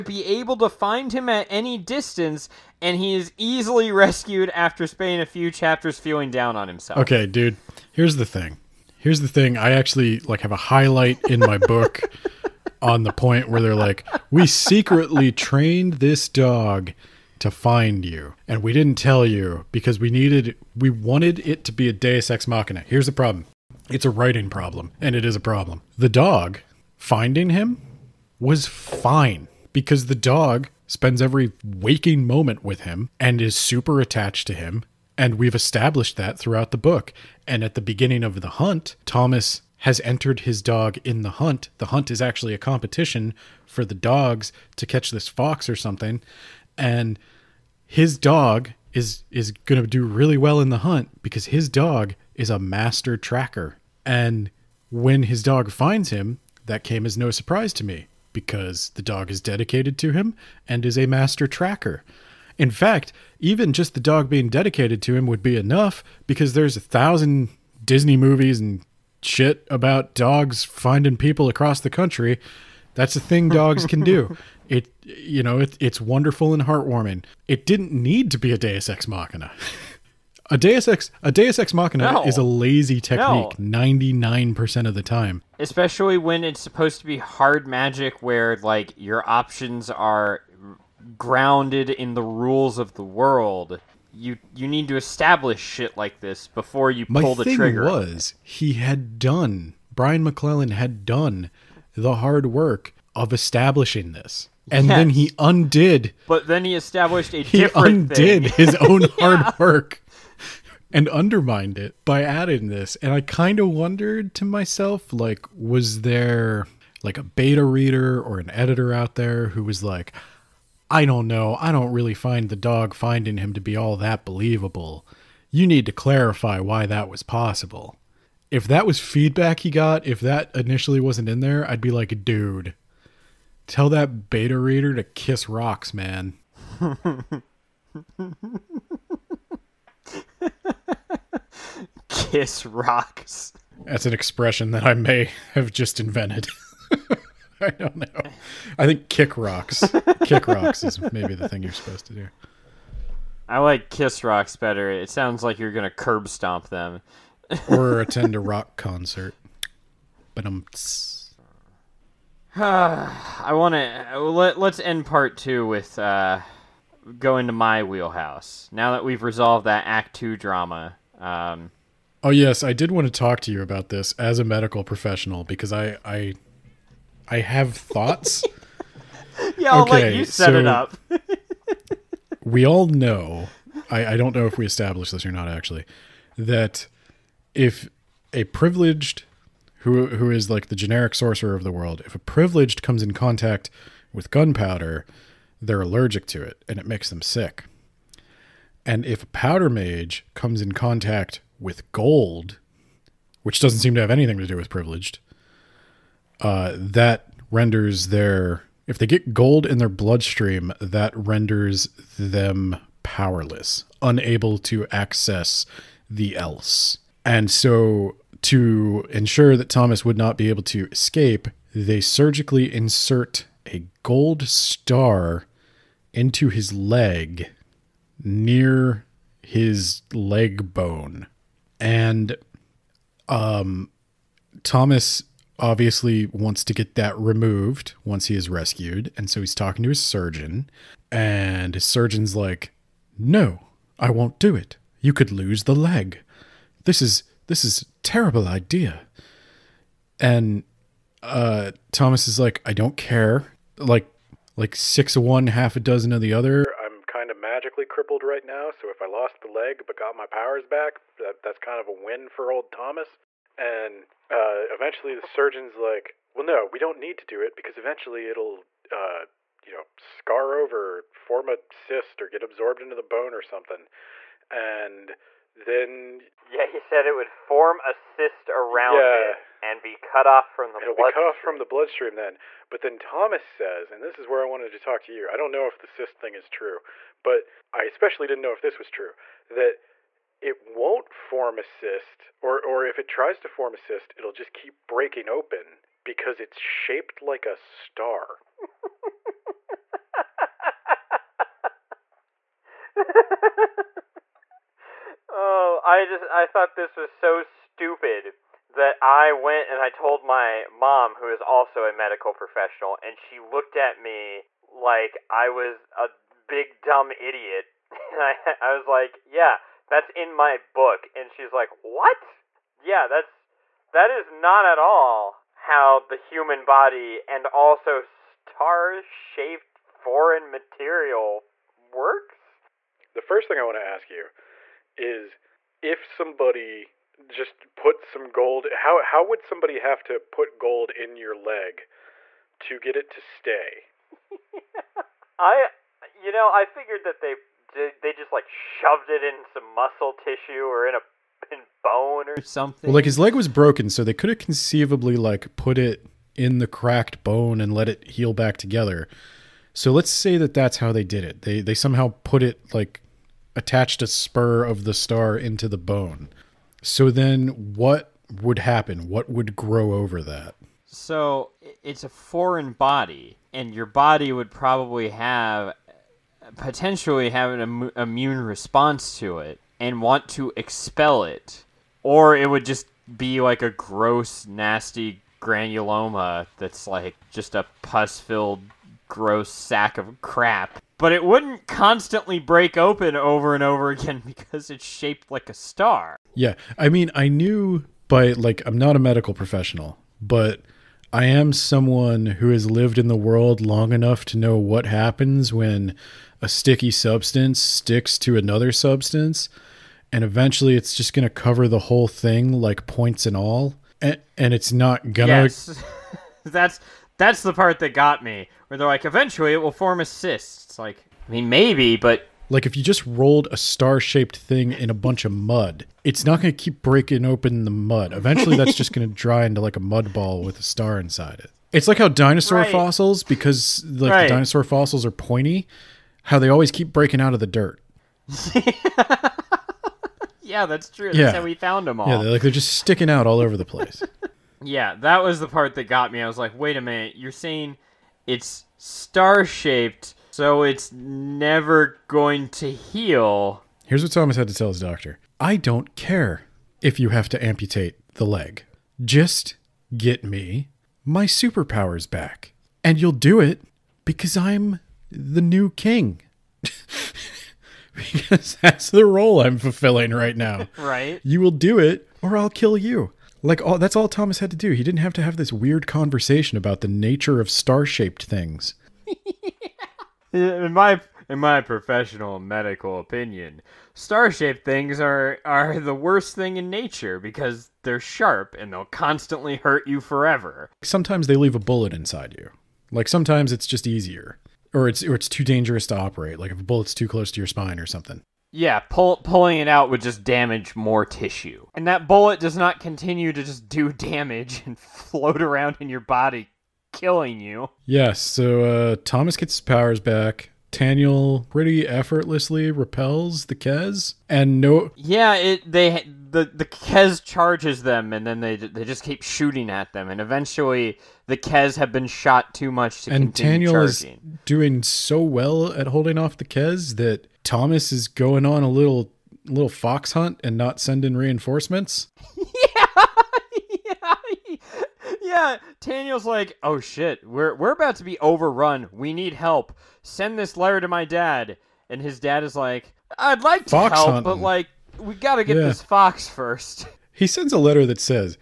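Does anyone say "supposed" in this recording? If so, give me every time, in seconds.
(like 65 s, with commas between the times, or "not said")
86 s, 151 s.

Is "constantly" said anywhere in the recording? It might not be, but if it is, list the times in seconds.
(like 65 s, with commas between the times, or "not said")
391 s, 488 s.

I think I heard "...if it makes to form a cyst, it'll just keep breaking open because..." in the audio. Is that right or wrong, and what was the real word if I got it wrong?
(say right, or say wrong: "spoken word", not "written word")
wrong: "tries", not "makes".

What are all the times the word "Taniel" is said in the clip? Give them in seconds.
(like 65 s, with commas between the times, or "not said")
510 s, 523 s, 535 s.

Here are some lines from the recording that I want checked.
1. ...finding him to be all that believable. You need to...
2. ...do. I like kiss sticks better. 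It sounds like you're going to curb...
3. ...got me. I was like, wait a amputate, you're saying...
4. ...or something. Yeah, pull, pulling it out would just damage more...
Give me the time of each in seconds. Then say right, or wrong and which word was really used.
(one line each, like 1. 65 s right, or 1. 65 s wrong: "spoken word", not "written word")
1. 122 s right
2. 152 s wrong: "rocks", not "sticks"
3. 445 s wrong: "minute", not "amputate"
4. 497 s right.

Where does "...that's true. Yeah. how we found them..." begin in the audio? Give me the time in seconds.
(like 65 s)
440 s.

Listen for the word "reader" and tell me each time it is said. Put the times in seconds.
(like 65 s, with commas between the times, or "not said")
117 s, 134 s.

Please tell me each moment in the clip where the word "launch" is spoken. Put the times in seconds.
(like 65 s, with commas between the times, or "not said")
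not said.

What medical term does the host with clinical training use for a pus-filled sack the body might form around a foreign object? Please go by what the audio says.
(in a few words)
granuloma.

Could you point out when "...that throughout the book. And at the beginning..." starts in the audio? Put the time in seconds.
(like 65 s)
36 s.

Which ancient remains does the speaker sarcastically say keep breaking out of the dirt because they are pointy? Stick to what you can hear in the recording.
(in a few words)
dinosaur fossils.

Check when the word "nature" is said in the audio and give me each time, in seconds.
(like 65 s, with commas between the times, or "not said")
476 s, 486 s.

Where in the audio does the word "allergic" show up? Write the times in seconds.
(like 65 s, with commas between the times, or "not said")
195 s.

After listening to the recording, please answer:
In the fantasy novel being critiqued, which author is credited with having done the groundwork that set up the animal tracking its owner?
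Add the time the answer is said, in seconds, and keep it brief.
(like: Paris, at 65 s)
Brian McClellan, at 99 s.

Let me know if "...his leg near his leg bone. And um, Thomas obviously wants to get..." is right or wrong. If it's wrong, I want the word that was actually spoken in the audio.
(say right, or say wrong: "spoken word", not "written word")
right.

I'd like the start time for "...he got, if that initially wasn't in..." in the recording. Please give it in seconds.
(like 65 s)
129 s.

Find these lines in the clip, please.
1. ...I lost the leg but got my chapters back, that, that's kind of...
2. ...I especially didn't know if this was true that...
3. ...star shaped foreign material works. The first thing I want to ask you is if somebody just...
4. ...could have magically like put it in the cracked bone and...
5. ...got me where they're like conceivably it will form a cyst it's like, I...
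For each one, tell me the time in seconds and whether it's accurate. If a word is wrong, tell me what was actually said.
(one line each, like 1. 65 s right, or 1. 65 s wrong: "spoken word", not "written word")
1. 259 s wrong: "powers", not "chapters"
2. 287 s right
3. 328 s right
4. 354 s wrong: "conceivably", not "magically"
5. 417 s wrong: "eventually", not "conceivably".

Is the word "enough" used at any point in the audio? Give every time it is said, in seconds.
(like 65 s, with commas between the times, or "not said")
65 s, 403 s.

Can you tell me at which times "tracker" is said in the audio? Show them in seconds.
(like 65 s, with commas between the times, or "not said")
53 s, 61 s.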